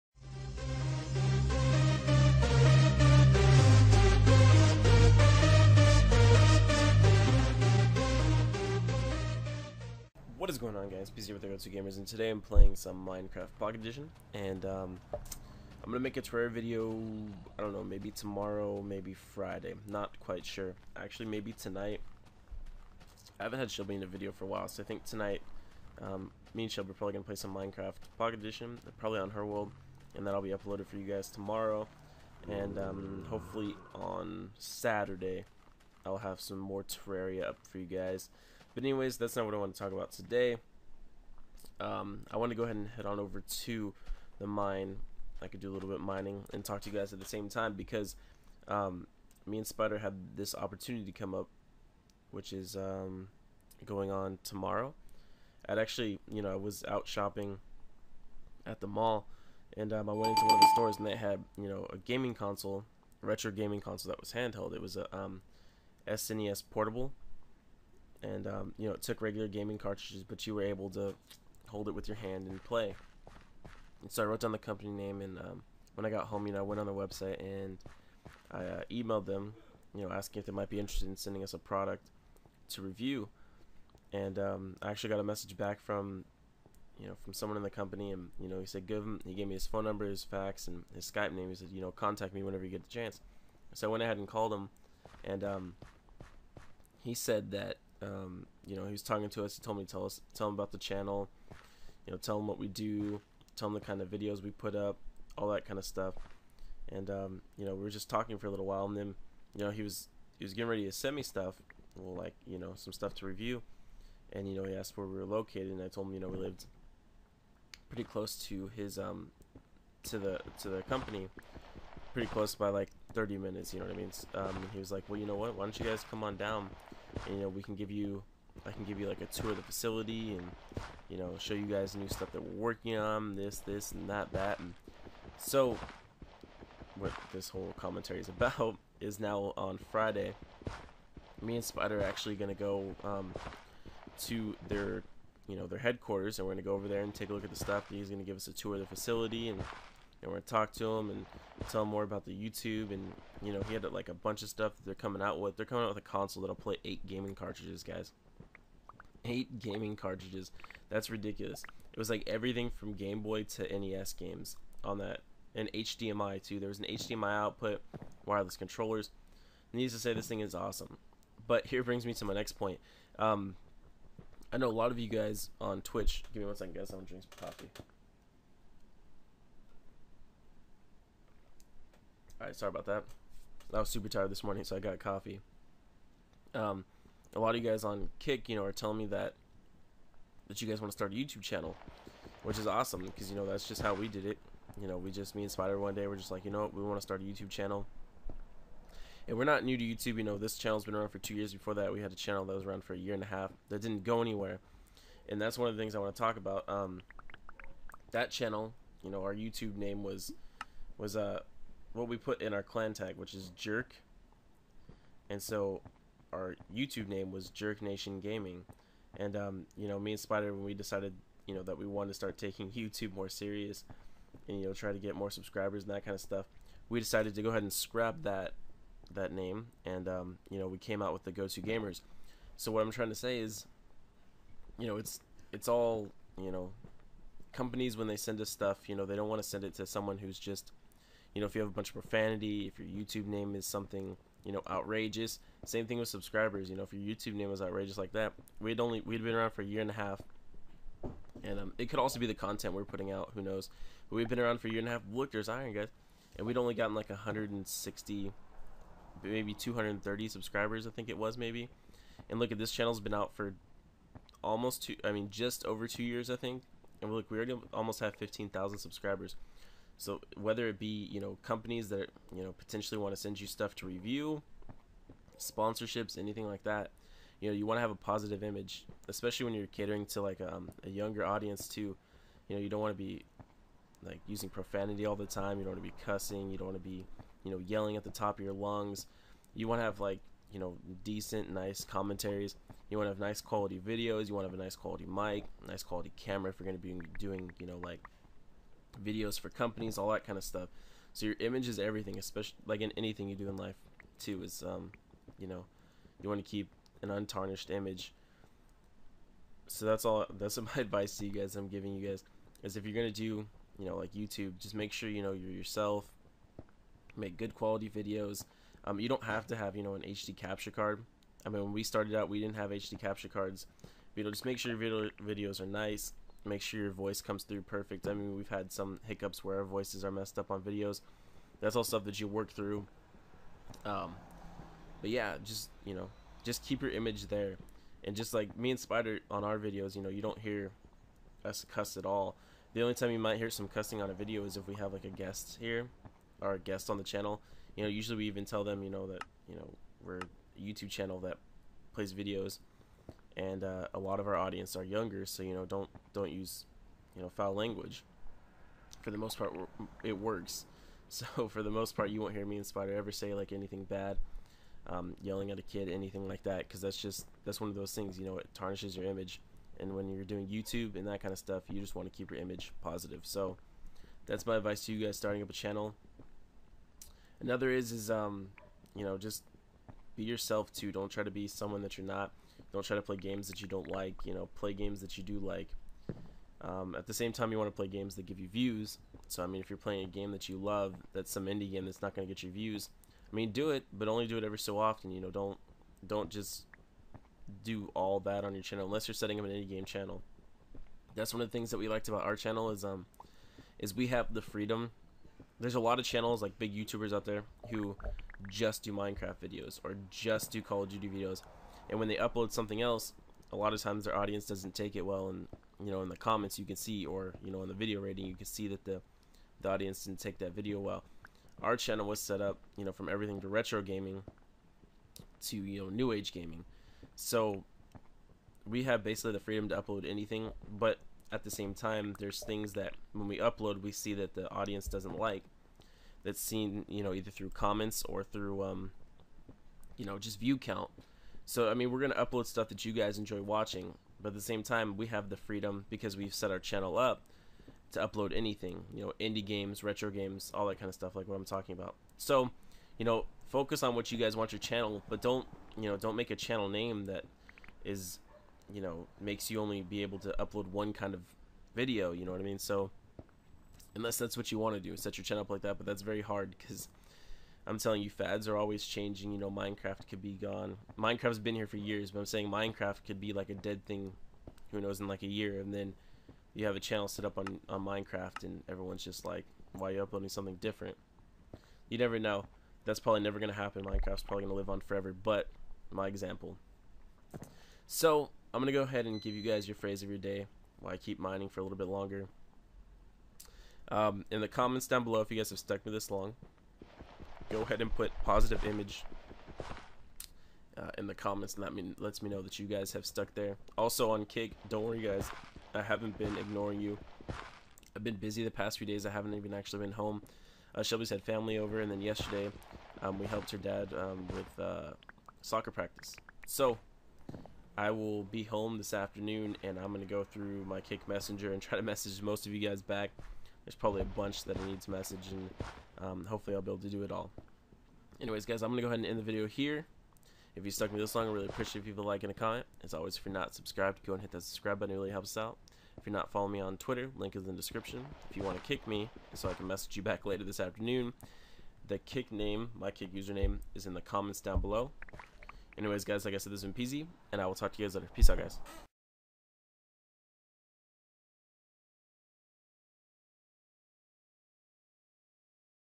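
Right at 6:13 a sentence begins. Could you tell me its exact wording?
So that's my advice to you guys starting up a channel.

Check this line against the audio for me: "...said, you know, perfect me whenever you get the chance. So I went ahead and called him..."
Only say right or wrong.
wrong.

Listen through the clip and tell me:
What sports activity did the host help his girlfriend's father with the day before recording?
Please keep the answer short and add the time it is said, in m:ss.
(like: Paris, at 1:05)
soccer practice, at 8:35.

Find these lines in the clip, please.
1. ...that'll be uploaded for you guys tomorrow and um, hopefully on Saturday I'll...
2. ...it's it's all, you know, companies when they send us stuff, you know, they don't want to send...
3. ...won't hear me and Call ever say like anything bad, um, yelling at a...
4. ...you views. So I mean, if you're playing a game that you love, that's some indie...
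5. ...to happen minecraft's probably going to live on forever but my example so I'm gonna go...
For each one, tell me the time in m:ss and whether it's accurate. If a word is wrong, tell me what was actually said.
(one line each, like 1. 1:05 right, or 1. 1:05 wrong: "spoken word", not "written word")
1. 0:30 right
2. 3:54 right
3. 6:02 wrong: "Spider", not "Call"
4. 6:28 right
5. 8:03 right.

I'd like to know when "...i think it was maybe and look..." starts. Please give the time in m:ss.
4:20.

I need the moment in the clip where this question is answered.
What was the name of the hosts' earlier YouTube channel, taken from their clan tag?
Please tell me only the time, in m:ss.
3:37.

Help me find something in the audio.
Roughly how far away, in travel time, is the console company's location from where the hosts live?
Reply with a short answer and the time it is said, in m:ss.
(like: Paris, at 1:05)
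30 minutes, at 2:03.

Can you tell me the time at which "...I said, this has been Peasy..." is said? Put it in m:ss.
9:06.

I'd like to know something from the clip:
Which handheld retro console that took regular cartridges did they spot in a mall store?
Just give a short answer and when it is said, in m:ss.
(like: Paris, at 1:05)
SNES portable, at 1:06.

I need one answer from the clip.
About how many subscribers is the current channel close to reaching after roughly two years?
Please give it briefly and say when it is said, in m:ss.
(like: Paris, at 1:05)
15,000, at 4:28.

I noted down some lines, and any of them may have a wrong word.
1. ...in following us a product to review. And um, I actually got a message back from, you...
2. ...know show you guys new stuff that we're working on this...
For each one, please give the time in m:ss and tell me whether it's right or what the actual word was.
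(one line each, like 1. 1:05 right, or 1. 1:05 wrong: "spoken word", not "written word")
1. 1:21 wrong: "sending", not "following"
2. 2:11 right.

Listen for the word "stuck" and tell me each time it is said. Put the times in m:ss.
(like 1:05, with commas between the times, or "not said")
8:15, 8:23, 8:50.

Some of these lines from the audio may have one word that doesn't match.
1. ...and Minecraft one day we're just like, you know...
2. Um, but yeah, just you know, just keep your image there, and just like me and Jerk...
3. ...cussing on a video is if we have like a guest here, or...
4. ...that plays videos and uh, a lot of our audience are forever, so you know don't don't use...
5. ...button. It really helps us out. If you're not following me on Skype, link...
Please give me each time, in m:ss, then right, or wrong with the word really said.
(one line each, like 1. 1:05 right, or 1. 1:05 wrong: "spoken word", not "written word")
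1. 3:15 wrong: "Spider", not "Minecraft"
2. 5:33 wrong: "Spider", not "Jerk"
3. 5:43 right
4. 5:51 wrong: "younger", not "forever"
5. 8:54 wrong: "Twitter", not "Skype".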